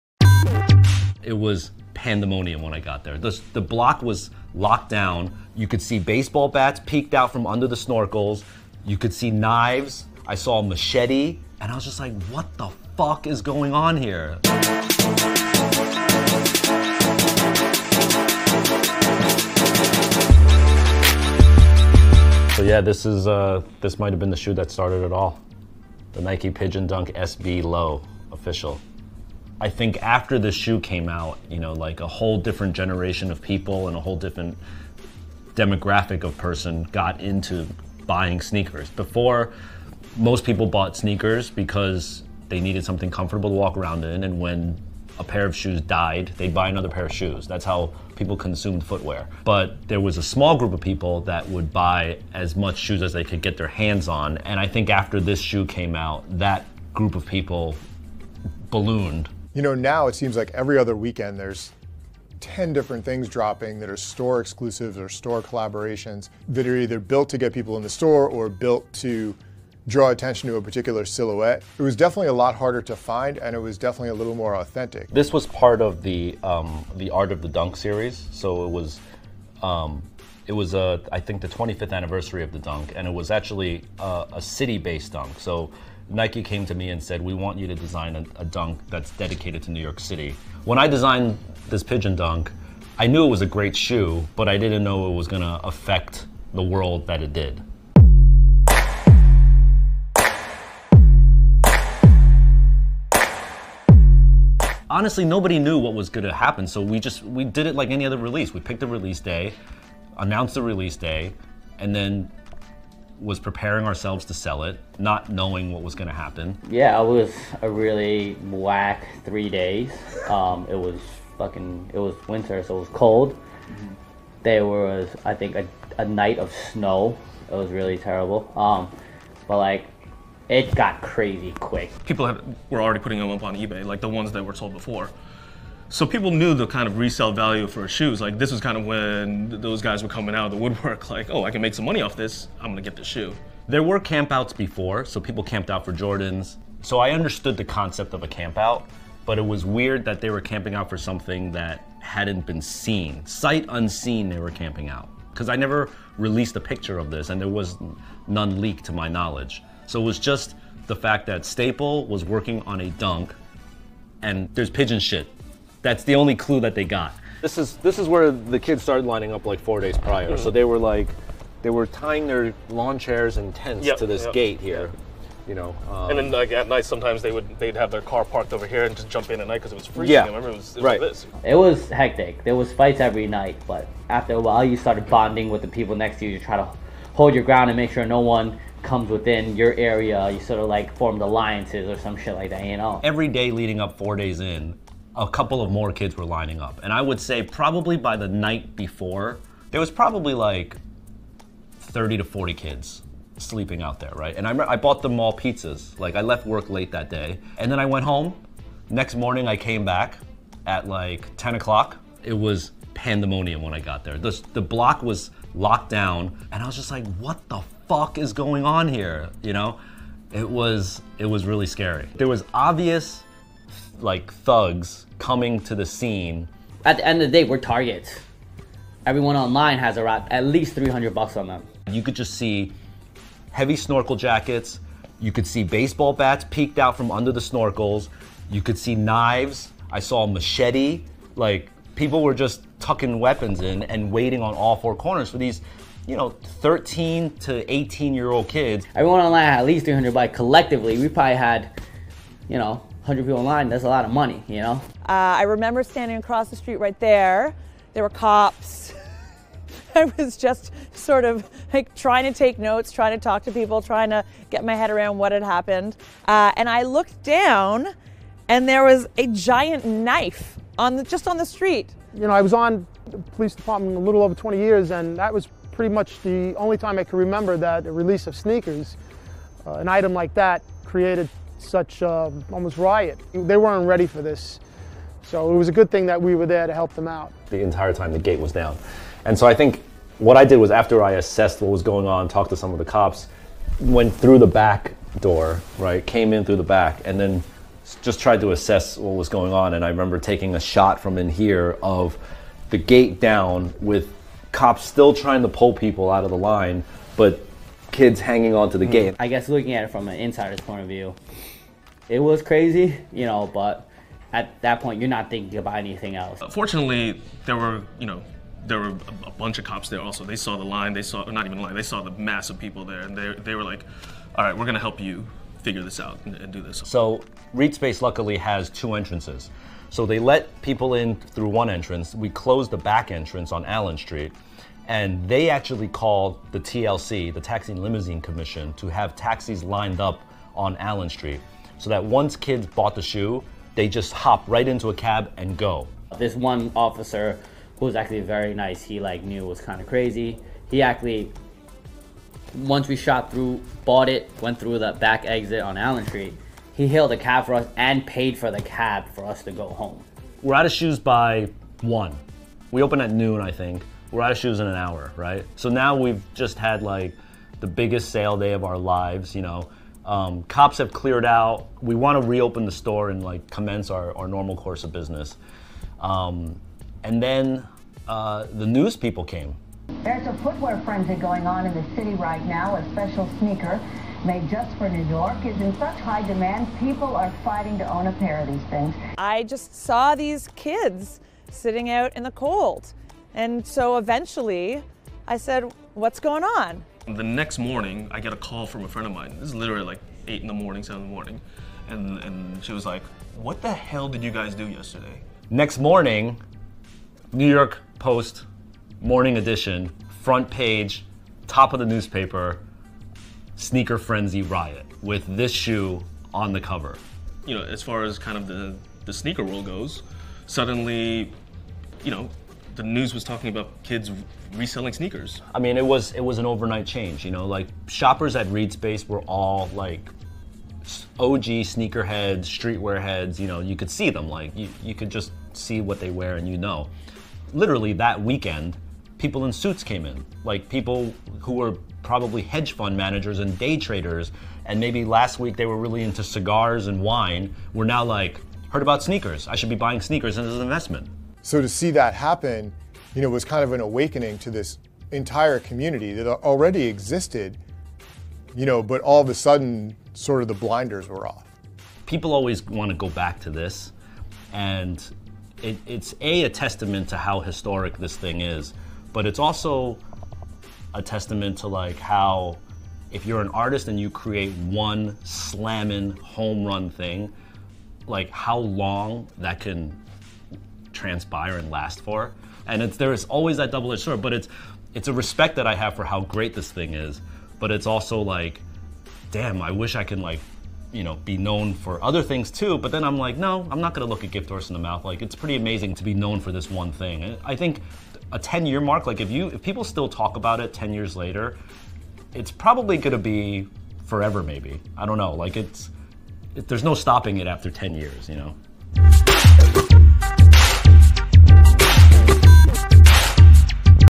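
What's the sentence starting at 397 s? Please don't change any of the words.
The next morning, I get a call from a friend of mine.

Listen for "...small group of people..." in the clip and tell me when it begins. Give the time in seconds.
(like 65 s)
50 s.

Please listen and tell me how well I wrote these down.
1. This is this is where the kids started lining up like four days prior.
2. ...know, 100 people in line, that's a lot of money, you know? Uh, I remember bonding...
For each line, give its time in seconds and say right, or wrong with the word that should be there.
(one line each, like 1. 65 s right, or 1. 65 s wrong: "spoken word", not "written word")
1. 167 s right
2. 252 s wrong: "standing", not "bonding".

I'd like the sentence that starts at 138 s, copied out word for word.
Like this was kind of when those guys were coming out of the woodwork.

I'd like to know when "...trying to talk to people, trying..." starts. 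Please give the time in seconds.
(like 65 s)
262 s.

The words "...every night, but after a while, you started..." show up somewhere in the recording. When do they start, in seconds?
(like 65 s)
182 s.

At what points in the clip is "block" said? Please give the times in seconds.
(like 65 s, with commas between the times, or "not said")
3 s, 214 s.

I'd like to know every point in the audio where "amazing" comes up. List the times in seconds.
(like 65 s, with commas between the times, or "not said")
495 s.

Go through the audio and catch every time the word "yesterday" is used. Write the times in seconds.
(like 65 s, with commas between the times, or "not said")
404 s.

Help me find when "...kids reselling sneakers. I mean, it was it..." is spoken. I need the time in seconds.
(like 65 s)
423 s.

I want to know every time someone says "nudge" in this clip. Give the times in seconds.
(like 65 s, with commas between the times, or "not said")
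not said.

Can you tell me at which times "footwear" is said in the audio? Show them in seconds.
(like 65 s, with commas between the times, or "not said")
48 s, 380 s.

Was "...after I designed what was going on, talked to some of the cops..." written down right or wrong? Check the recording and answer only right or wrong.
wrong.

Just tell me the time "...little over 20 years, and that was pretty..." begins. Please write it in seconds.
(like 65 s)
273 s.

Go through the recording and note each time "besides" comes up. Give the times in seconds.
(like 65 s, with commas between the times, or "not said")
not said.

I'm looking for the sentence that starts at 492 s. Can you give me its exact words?
But then I'm like, no, I'm not gonna look a gift horse in the mouth.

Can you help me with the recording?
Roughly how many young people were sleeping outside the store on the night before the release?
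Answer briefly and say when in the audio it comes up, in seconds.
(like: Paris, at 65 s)
30 to 40, at 201 s.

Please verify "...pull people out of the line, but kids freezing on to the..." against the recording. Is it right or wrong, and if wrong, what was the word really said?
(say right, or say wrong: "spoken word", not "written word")
wrong: "hanging", not "freezing".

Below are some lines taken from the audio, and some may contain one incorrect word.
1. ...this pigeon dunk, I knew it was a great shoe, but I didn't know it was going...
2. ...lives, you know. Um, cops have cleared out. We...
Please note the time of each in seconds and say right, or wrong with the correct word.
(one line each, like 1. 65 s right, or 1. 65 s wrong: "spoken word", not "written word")
1. 91 s right
2. 368 s right.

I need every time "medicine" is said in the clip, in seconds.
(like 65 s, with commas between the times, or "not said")
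not said.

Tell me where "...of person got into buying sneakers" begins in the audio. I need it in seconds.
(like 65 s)
36 s.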